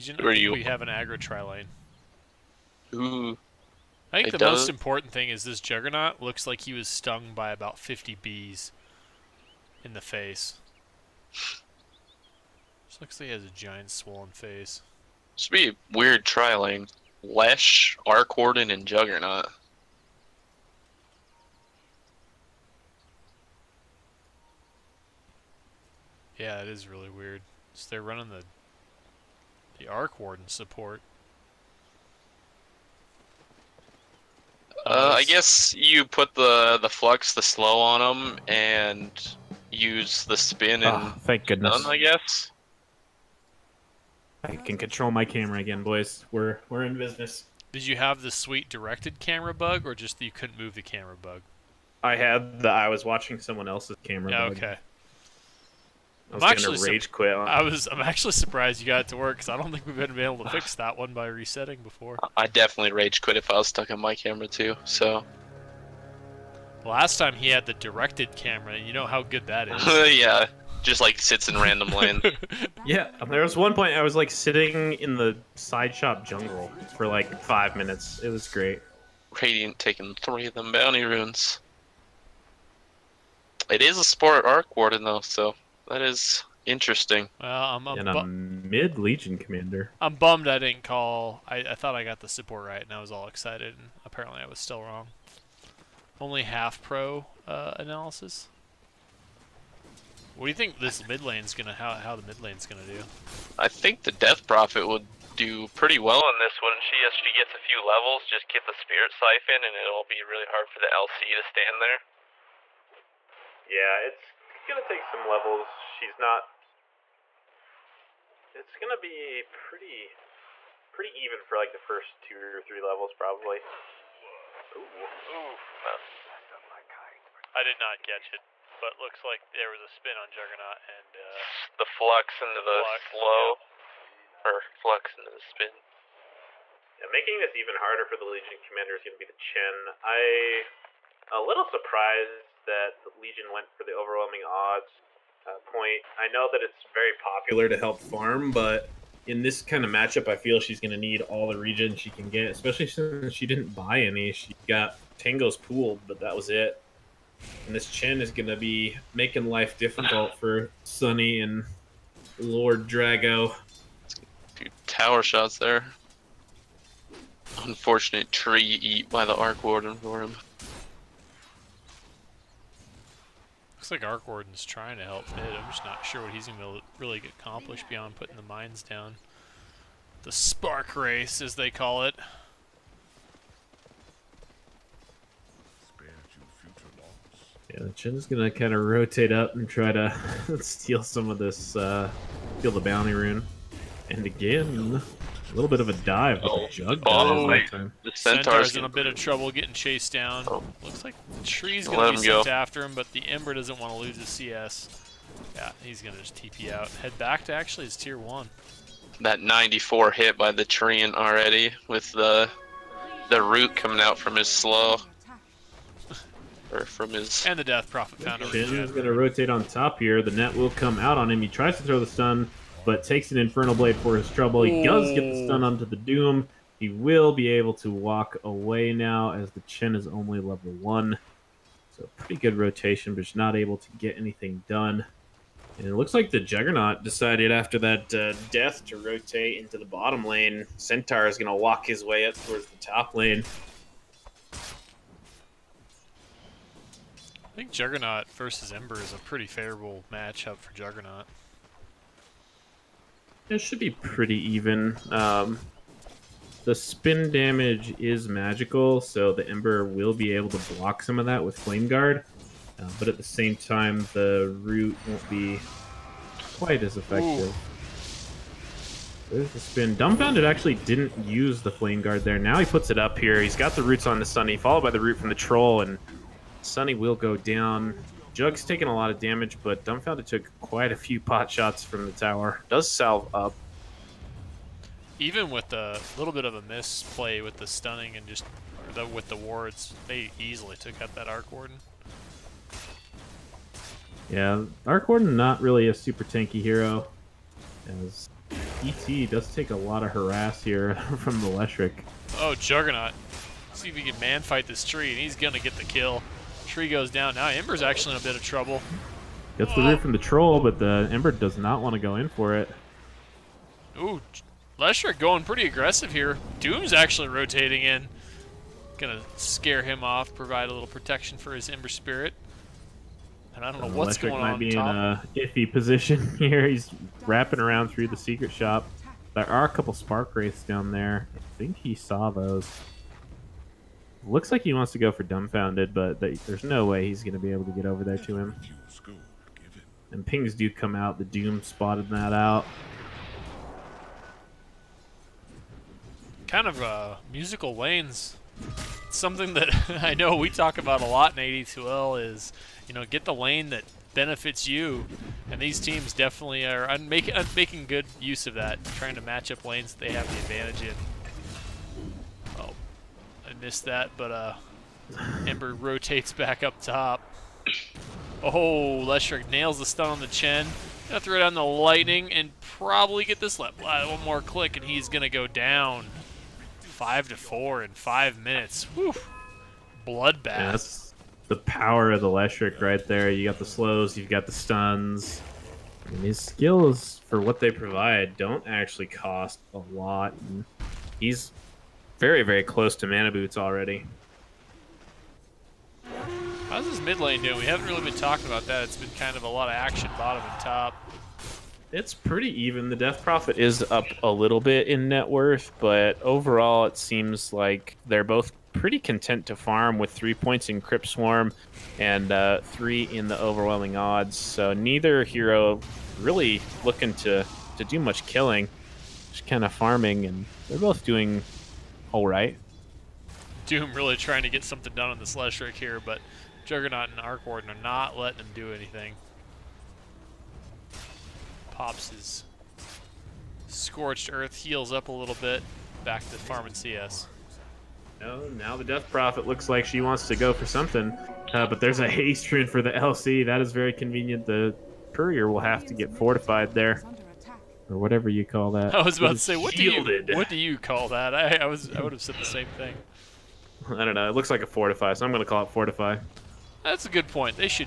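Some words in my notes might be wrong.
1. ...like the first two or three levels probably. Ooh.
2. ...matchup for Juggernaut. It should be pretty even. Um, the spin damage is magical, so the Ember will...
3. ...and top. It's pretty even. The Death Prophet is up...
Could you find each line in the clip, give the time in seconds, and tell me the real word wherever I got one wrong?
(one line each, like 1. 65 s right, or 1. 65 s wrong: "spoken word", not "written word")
1. 121 s right
2. 250 s right
3. 400 s right.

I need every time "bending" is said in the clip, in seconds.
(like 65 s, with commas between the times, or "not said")
not said.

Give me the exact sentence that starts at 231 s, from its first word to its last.
So pretty good rotation, but just not able to get anything done.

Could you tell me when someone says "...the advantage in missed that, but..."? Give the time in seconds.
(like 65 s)
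360 s.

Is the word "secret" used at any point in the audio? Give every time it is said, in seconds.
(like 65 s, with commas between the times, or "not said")
328 s.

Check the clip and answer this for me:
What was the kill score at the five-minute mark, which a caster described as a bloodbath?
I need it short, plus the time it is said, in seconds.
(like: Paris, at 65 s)
5 to 4, at 376 s.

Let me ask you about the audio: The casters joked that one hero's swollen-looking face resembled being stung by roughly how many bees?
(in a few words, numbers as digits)
50.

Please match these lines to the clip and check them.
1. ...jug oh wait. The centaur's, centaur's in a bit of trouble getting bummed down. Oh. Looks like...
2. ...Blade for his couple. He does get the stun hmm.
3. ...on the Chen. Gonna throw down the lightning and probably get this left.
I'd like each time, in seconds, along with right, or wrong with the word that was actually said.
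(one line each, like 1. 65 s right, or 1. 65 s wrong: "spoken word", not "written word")
1. 196 s wrong: "chased", not "bummed"
2. 223 s wrong: "trouble", not "couple"
3. 370 s right.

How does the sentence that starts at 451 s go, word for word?
I, I was I would have said the same thing.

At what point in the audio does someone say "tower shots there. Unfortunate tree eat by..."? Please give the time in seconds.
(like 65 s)
164 s.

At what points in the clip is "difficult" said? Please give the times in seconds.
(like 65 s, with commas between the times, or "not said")
159 s.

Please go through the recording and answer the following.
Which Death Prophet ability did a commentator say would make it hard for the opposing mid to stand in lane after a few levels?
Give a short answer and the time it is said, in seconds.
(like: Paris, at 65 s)
Spirit Siphon, at 108 s.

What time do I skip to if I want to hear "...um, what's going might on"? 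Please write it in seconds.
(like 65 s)
323 s.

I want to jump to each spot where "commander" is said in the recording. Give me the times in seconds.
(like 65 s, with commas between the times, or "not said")
89 s, 138 s.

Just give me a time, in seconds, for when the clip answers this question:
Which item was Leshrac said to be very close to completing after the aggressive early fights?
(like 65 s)
393 s.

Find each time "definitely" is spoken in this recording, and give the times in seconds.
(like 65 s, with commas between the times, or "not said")
62 s, 356 s.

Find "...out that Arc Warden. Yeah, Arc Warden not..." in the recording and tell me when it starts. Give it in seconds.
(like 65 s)
291 s.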